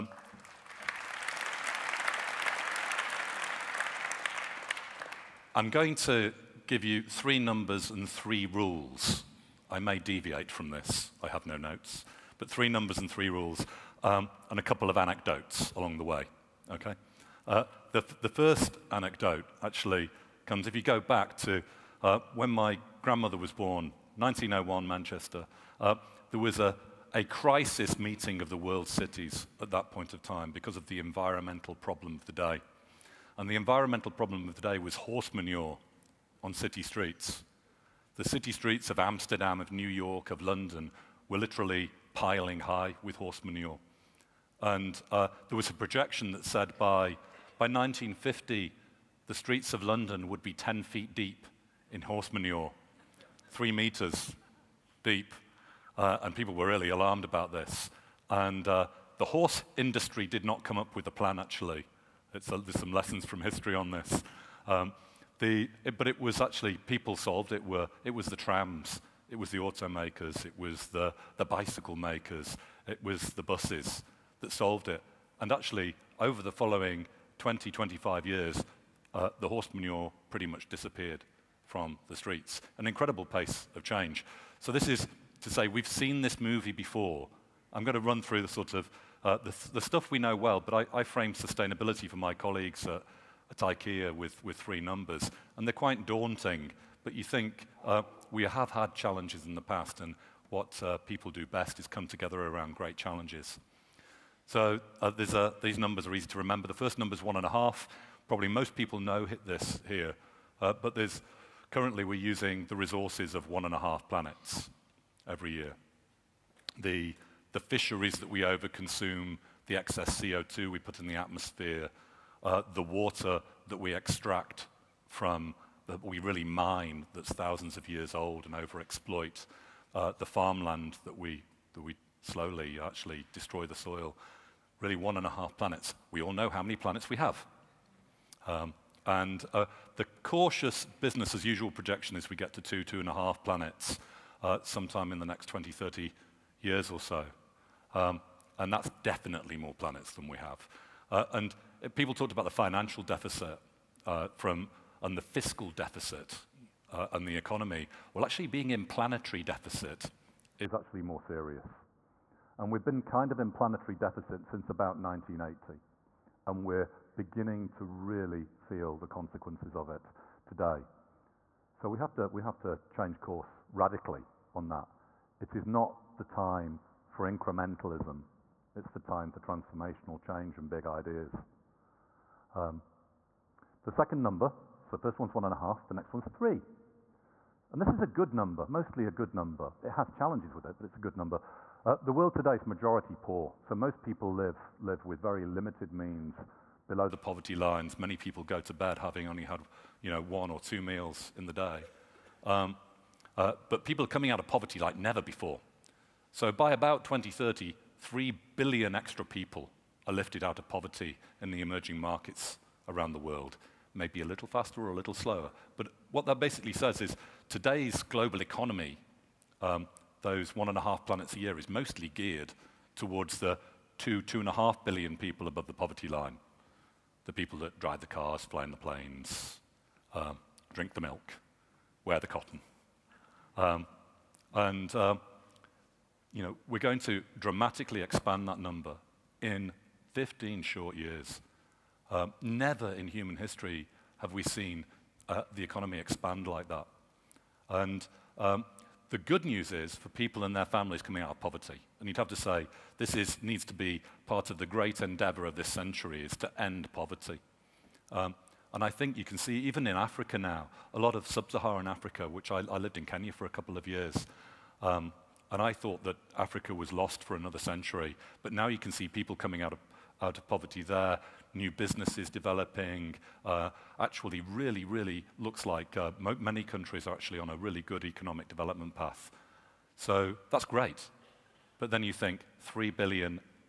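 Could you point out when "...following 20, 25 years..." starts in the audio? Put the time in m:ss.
1:16.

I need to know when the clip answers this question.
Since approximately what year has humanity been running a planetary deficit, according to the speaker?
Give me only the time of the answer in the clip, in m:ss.
2:44.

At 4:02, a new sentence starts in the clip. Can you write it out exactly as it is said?
Um, never in human history have we seen uh, the economy expand like that.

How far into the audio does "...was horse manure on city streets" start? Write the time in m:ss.
0:34.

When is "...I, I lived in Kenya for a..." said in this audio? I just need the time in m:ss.
4:22.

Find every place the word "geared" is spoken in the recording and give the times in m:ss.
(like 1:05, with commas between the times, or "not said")
3:42.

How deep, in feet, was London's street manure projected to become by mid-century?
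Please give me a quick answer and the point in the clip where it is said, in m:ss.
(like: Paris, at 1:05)
10 feet, at 0:50.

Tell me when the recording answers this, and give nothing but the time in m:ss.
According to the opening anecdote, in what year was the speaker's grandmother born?
0:24.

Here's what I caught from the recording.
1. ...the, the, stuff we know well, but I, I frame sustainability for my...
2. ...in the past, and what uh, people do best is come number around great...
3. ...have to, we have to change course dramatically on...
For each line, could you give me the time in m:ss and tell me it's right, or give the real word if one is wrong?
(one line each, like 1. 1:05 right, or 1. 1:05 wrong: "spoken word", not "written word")
1. 1:29 right
2. 1:39 wrong: "together", not "number"
3. 2:51 wrong: "radically", not "dramatically".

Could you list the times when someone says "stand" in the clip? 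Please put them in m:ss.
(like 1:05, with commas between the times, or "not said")
not said.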